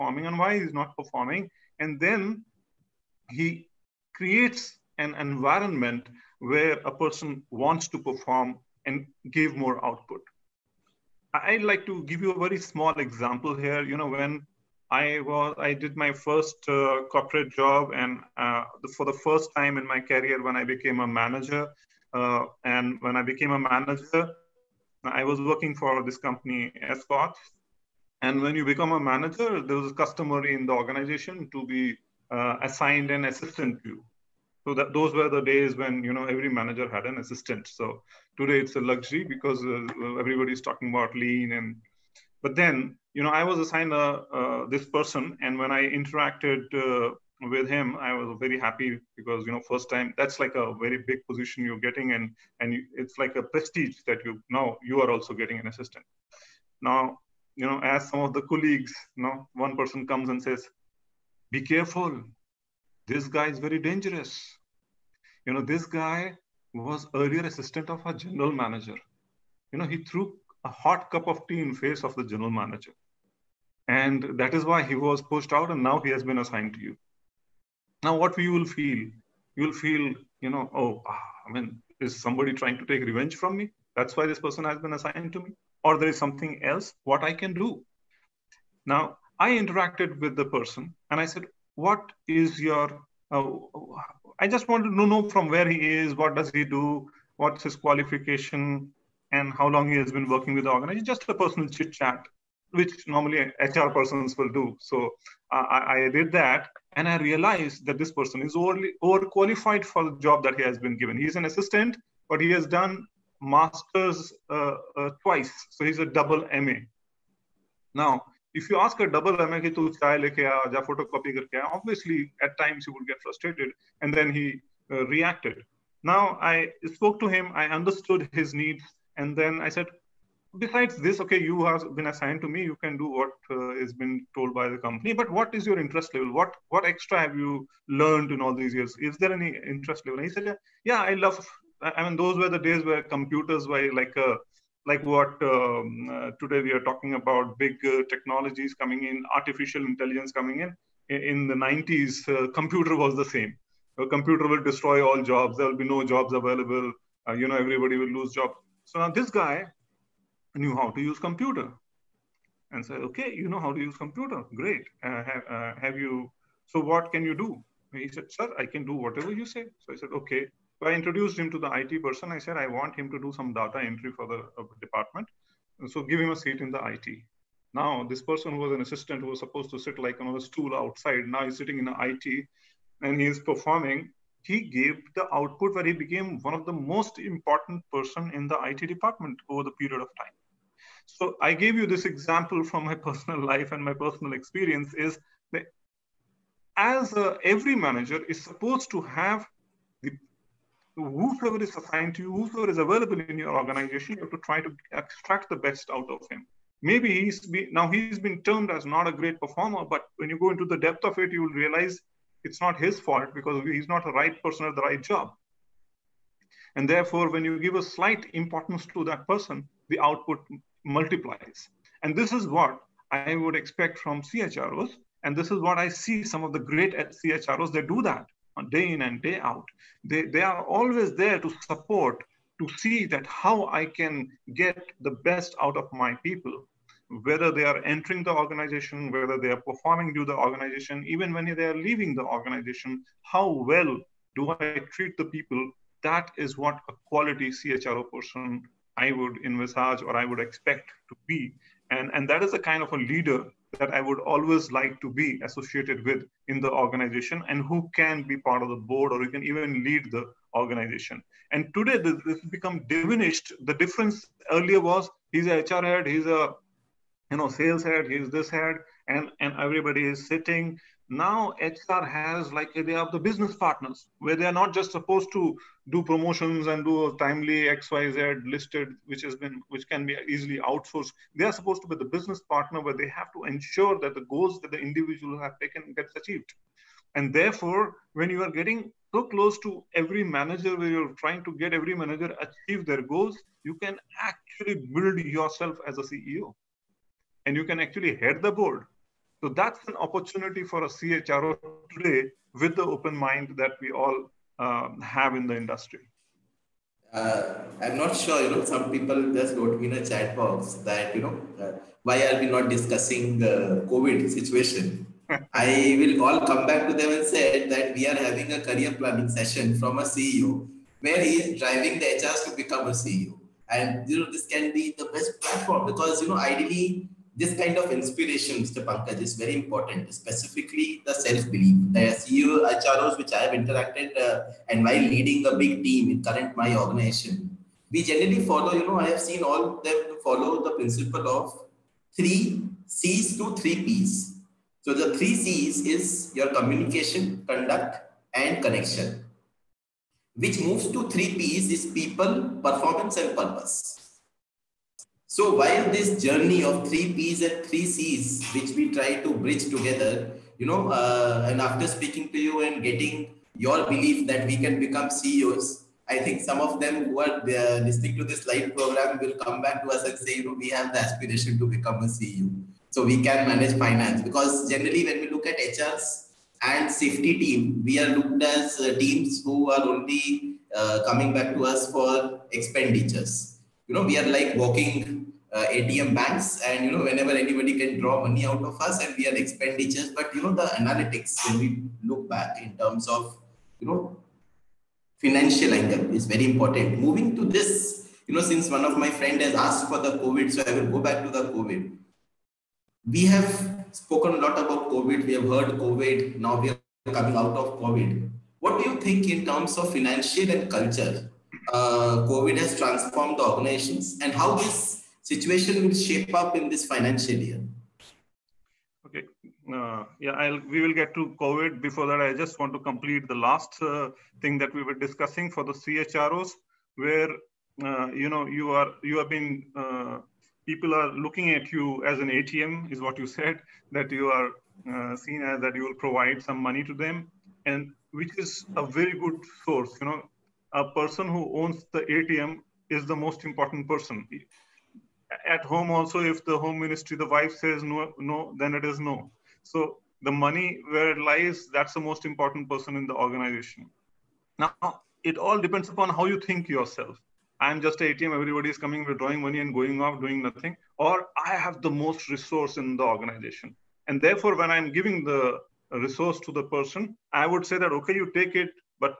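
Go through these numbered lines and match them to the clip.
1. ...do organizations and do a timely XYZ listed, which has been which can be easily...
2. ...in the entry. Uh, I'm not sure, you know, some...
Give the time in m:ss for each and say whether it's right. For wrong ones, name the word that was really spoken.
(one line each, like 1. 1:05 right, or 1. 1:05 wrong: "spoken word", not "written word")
1. 4:35 wrong: "promotions", not "organizations"
2. 5:05 wrong: "industry", not "entry".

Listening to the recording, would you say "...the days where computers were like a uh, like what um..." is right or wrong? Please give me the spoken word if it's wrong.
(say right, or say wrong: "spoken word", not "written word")
right.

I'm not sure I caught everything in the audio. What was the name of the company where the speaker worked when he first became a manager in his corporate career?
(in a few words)
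Escort.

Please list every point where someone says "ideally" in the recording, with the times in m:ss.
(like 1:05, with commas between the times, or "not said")
5:26.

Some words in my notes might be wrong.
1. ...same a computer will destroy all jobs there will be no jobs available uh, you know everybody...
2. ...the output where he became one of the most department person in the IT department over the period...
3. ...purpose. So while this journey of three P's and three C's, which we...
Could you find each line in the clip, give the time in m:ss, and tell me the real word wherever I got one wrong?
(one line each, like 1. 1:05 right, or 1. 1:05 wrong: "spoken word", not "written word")
1. 2:33 right
2. 3:05 wrong: "important", not "department"
3. 5:53 right.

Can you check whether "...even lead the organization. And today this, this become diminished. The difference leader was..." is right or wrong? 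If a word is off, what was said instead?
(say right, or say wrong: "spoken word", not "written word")
wrong: "earlier", not "leader".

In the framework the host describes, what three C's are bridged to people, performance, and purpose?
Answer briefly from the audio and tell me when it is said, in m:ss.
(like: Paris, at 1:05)
communication, conduct, and connection, at 5:46.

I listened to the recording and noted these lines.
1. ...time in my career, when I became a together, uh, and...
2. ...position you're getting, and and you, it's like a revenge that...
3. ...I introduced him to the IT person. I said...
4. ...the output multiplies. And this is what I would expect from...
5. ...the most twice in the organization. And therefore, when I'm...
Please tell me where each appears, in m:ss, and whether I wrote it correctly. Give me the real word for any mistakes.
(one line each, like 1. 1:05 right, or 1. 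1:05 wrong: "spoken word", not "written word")
1. 0:19 wrong: "manager", not "together"
2. 0:51 wrong: "prestige", not "revenge"
3. 2:50 right
4. 3:39 right
5. 7:41 wrong: "resource", not "twice".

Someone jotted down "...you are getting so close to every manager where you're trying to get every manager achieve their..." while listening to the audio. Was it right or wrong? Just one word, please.
right.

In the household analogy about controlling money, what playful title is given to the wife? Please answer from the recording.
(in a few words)
home ministry.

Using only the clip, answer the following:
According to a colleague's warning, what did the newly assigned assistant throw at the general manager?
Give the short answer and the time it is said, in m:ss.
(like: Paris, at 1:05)
hot cup of tea, at 1:10.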